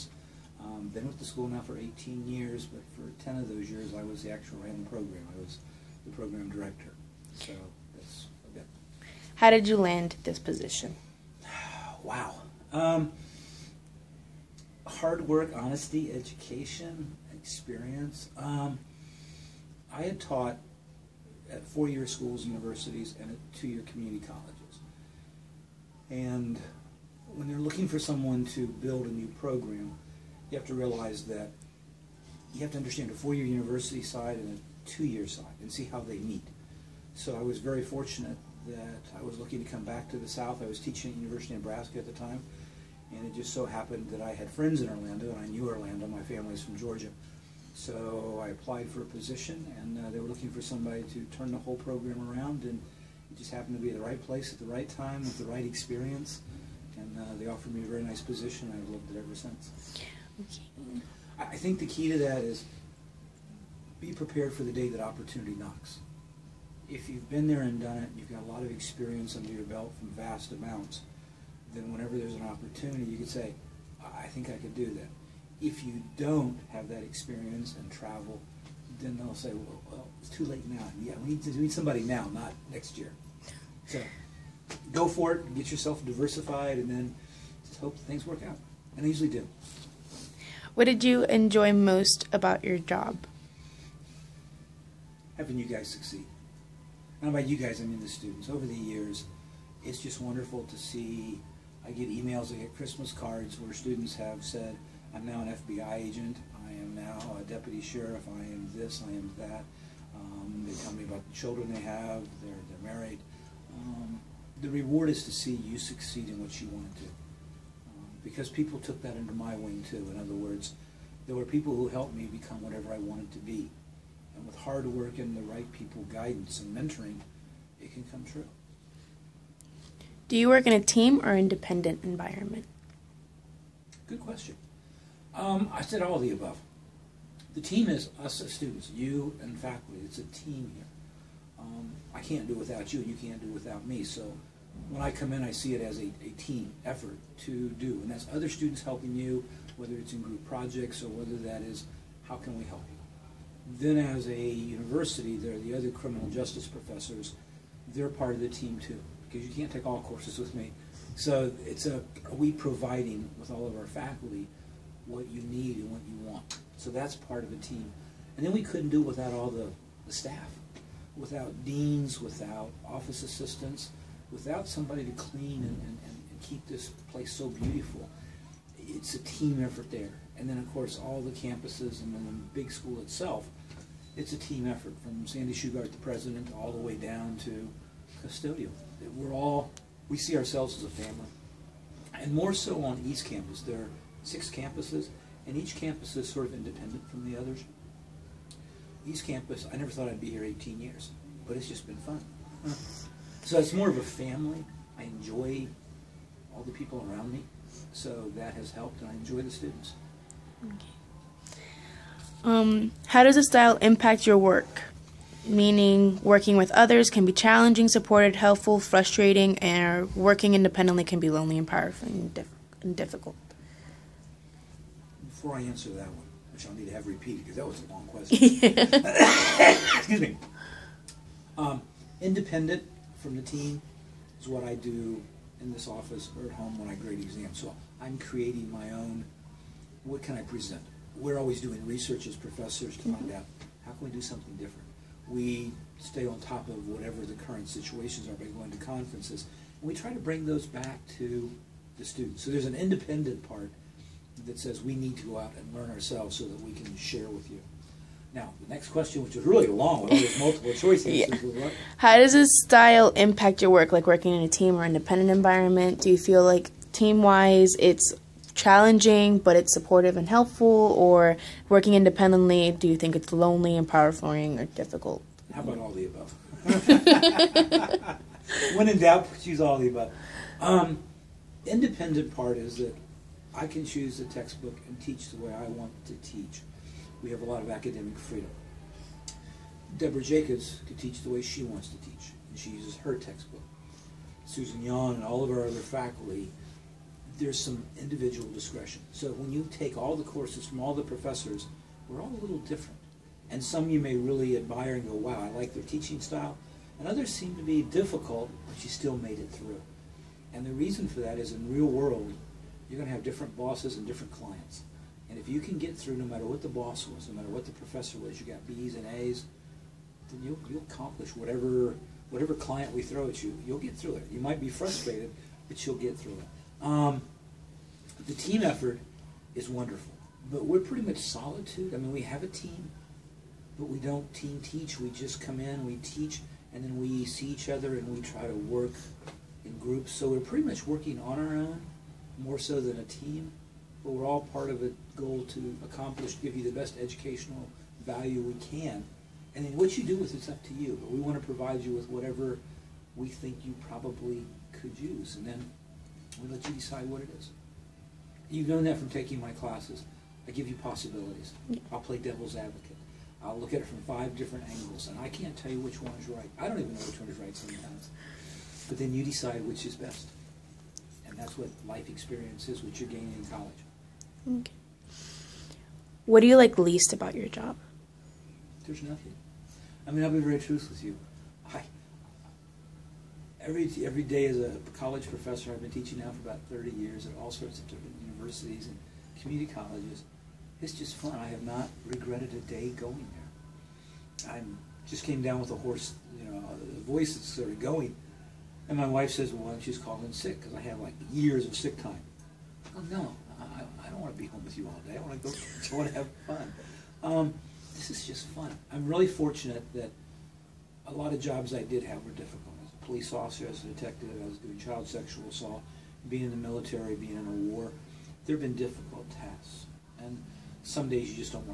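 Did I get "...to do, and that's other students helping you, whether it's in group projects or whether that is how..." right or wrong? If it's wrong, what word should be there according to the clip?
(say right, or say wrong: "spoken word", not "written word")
right.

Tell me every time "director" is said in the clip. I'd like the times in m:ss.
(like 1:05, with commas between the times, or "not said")
0:06.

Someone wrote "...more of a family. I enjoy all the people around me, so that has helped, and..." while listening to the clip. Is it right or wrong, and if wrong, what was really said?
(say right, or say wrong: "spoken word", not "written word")
right.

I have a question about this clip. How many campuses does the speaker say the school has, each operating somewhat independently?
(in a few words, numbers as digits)
6.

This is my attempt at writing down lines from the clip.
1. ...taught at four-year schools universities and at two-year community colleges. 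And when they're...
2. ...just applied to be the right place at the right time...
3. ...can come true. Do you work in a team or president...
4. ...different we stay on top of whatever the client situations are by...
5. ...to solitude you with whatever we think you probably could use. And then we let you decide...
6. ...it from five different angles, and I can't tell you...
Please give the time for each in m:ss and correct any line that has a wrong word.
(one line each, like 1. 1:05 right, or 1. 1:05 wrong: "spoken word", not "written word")
1. 0:20 right
2. 0:53 wrong: "happened", not "applied"
3. 2:07 wrong: "independent", not "president"
4. 4:04 wrong: "current", not "client"
5. 5:51 wrong: "provide", not "solitude"
6. 6:03 right.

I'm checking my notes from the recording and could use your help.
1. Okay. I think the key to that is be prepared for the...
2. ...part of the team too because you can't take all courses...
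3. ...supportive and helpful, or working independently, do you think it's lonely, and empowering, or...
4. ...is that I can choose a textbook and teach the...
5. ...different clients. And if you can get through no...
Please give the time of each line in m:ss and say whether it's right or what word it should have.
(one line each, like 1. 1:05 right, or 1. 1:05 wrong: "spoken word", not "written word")
1. 1:00 right
2. 2:38 right
3. 4:29 right
4. 4:42 right
5. 5:14 right.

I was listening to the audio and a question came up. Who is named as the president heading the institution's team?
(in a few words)
Sandy Shugart.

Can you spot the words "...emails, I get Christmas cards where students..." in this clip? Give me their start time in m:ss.
1:42.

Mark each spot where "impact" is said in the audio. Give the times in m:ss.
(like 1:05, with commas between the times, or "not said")
3:33, 4:23.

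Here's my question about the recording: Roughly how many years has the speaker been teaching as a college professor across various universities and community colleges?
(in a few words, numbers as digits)
30.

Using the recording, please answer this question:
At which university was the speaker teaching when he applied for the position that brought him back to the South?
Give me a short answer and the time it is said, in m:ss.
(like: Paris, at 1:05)
University of Nebraska, at 0:41.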